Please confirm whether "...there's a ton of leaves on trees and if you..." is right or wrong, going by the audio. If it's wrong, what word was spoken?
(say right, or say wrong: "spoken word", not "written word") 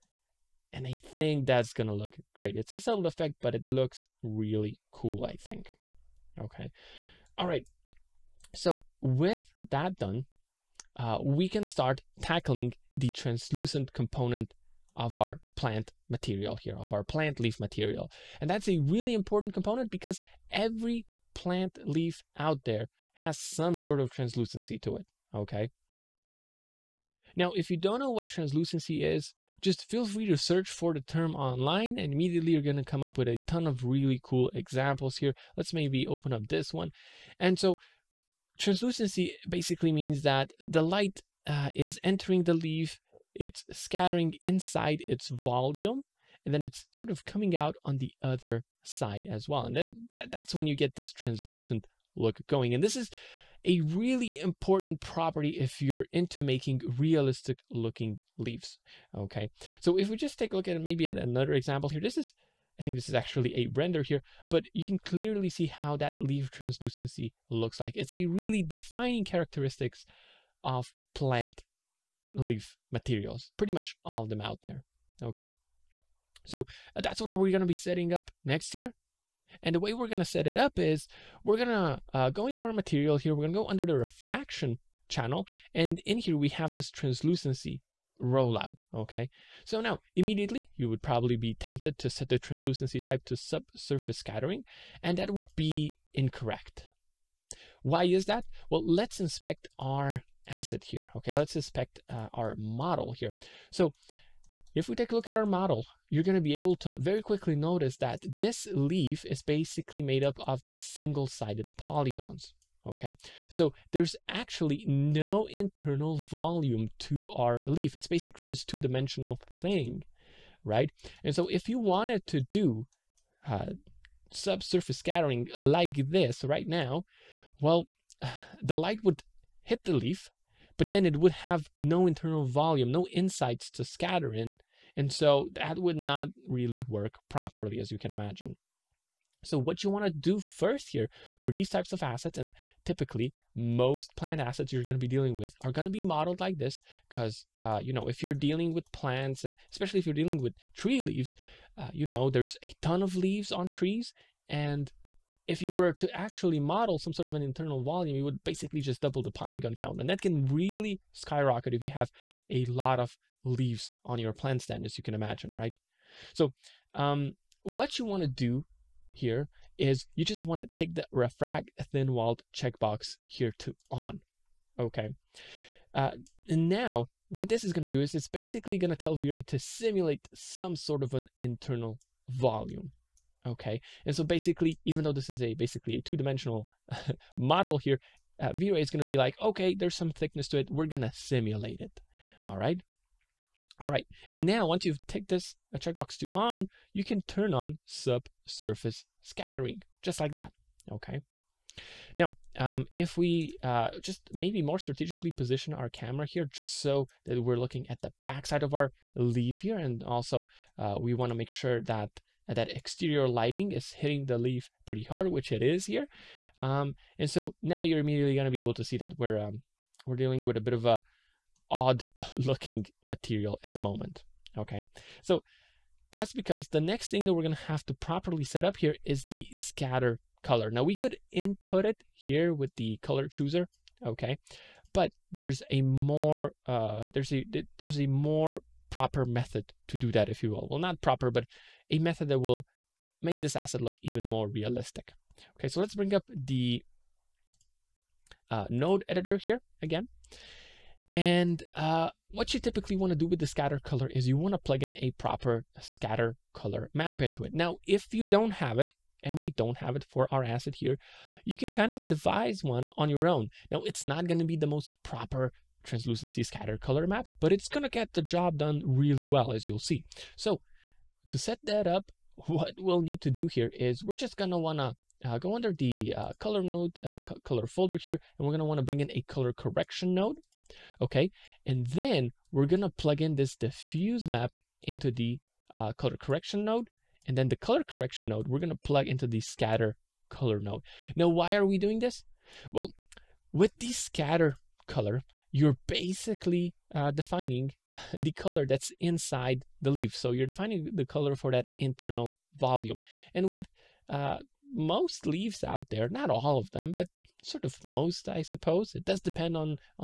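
right.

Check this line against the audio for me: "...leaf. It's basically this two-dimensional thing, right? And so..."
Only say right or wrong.
right.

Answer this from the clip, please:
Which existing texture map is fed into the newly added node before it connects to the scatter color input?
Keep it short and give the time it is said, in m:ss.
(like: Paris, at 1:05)
Diffuse map, at 4:43.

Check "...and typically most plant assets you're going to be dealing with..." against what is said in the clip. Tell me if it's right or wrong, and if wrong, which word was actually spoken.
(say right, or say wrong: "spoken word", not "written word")
right.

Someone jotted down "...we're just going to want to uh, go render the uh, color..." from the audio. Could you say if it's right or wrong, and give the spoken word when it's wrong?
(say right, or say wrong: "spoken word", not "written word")
wrong: "under", not "render".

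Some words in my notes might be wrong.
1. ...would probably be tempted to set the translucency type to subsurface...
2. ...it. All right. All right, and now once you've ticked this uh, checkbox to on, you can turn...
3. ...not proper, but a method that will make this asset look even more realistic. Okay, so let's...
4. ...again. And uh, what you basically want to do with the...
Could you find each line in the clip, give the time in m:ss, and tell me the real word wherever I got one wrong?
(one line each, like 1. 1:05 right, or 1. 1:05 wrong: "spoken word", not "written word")
1. 1:30 right
2. 3:11 right
3. 4:00 right
4. 4:09 wrong: "typically", not "basically".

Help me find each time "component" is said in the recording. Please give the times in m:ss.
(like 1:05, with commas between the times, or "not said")
0:13, 0:19.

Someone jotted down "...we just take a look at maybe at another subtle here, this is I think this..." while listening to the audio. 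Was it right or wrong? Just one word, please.
wrong.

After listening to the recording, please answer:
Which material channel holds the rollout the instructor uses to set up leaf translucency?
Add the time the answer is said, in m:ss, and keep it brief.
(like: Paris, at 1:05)
Refraction, at 1:23.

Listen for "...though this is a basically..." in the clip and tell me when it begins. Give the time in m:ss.
3:05.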